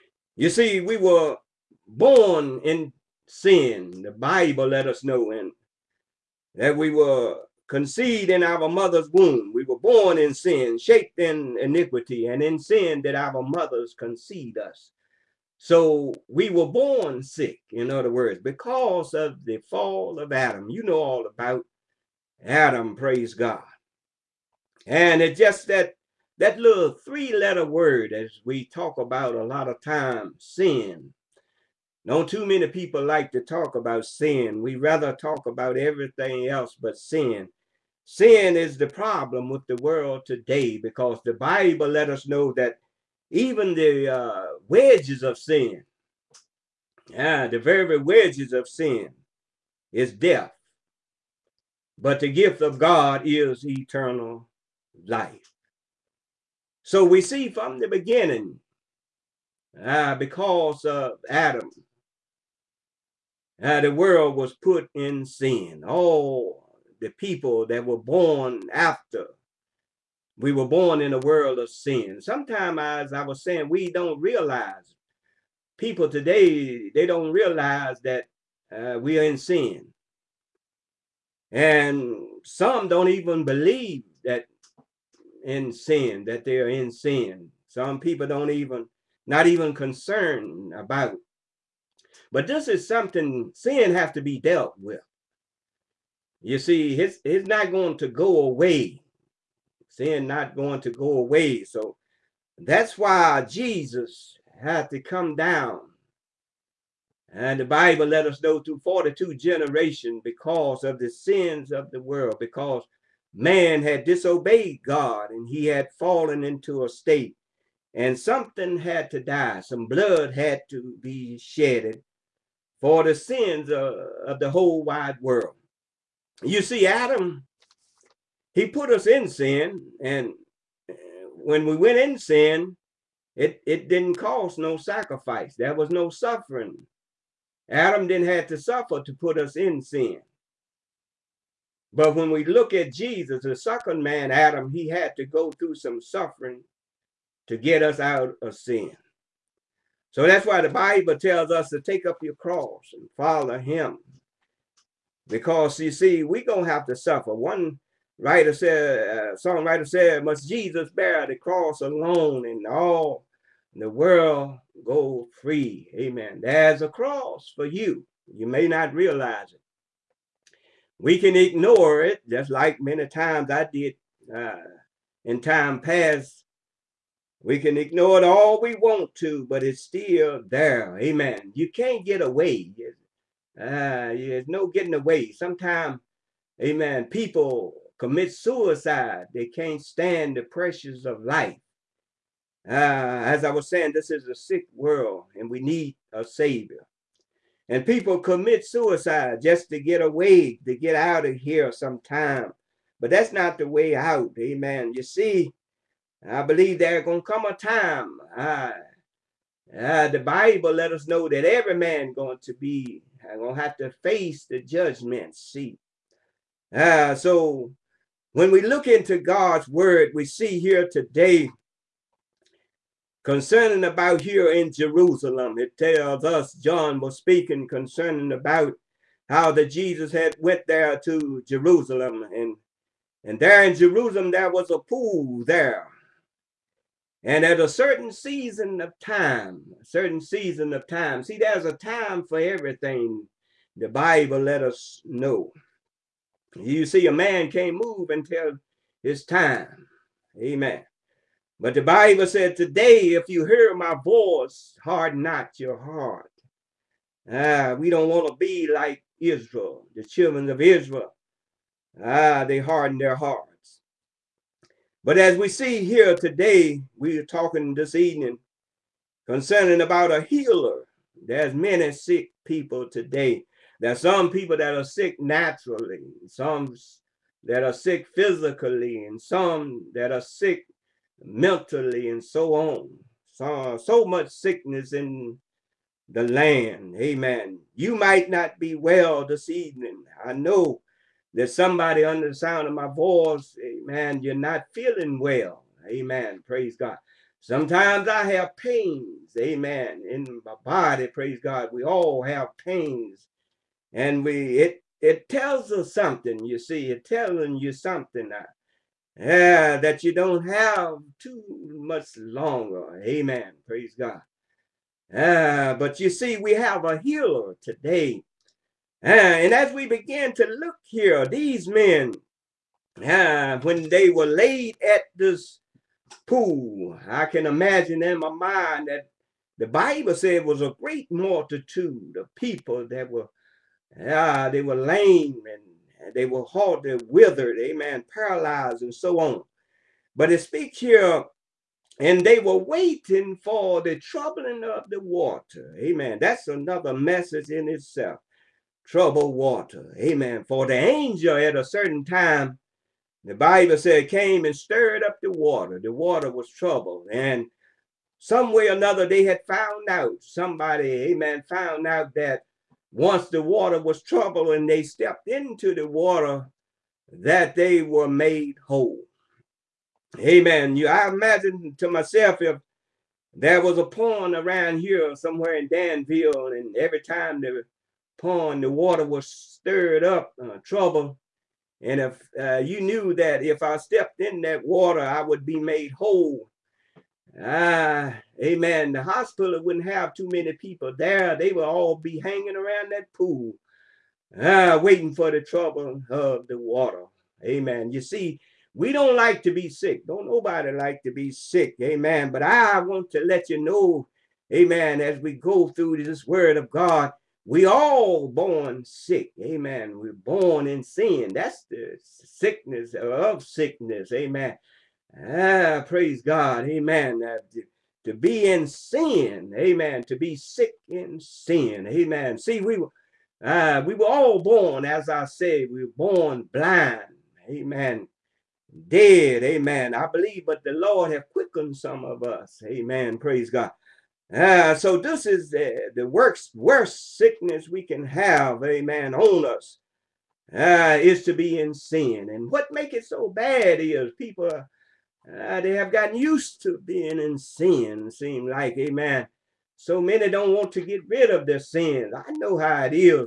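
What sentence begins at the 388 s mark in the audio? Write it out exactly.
The hospital wouldn't have too many people there.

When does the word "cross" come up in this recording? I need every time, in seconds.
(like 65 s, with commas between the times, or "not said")
152 s, 161 s, 166 s.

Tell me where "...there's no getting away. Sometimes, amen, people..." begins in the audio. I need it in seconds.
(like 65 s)
184 s.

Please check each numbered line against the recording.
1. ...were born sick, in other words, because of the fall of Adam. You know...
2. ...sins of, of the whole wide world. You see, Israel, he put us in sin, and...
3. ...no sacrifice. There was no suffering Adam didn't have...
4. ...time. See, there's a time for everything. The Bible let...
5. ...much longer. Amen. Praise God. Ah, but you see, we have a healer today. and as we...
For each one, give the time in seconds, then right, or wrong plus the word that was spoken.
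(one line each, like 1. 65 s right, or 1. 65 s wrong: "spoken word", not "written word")
1. 16 s right
2. 123 s wrong: "Adam", not "Israel"
3. 134 s right
4. 240 s right
5. 311 s right.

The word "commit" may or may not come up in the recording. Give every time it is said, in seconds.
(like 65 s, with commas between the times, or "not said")
187 s, 198 s.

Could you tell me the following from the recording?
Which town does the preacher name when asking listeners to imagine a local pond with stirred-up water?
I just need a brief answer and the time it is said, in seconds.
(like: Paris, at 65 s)
Danville, at 375 s.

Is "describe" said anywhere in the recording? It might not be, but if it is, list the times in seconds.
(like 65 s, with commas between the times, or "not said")
not said.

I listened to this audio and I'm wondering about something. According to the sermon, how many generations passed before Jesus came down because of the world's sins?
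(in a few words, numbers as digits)
42.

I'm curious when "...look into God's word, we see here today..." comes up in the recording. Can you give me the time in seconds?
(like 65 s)
218 s.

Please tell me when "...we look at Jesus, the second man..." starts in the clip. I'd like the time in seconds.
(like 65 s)
142 s.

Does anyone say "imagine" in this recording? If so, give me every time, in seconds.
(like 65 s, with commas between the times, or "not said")
327 s, 371 s.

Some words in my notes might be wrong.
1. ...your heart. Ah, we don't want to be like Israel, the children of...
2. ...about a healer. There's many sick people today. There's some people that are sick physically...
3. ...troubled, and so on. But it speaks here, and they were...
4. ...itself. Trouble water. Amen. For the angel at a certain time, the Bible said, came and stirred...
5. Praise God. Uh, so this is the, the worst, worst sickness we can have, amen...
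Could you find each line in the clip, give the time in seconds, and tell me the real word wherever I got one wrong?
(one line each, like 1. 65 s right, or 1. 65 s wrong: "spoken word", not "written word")
1. 255 s right
2. 269 s wrong: "naturally", not "physically"
3. 338 s wrong: "paralyzed", not "troubled"
4. 347 s right
5. 433 s right.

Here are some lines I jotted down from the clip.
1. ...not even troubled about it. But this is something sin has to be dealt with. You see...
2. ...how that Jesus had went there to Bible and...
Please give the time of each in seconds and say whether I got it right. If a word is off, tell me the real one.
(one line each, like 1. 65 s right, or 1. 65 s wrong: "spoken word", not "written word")
1. 89 s wrong: "concerned", not "troubled"
2. 229 s wrong: "Jerusalem", not "Bible".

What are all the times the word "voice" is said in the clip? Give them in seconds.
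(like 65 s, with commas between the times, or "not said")
254 s, 292 s.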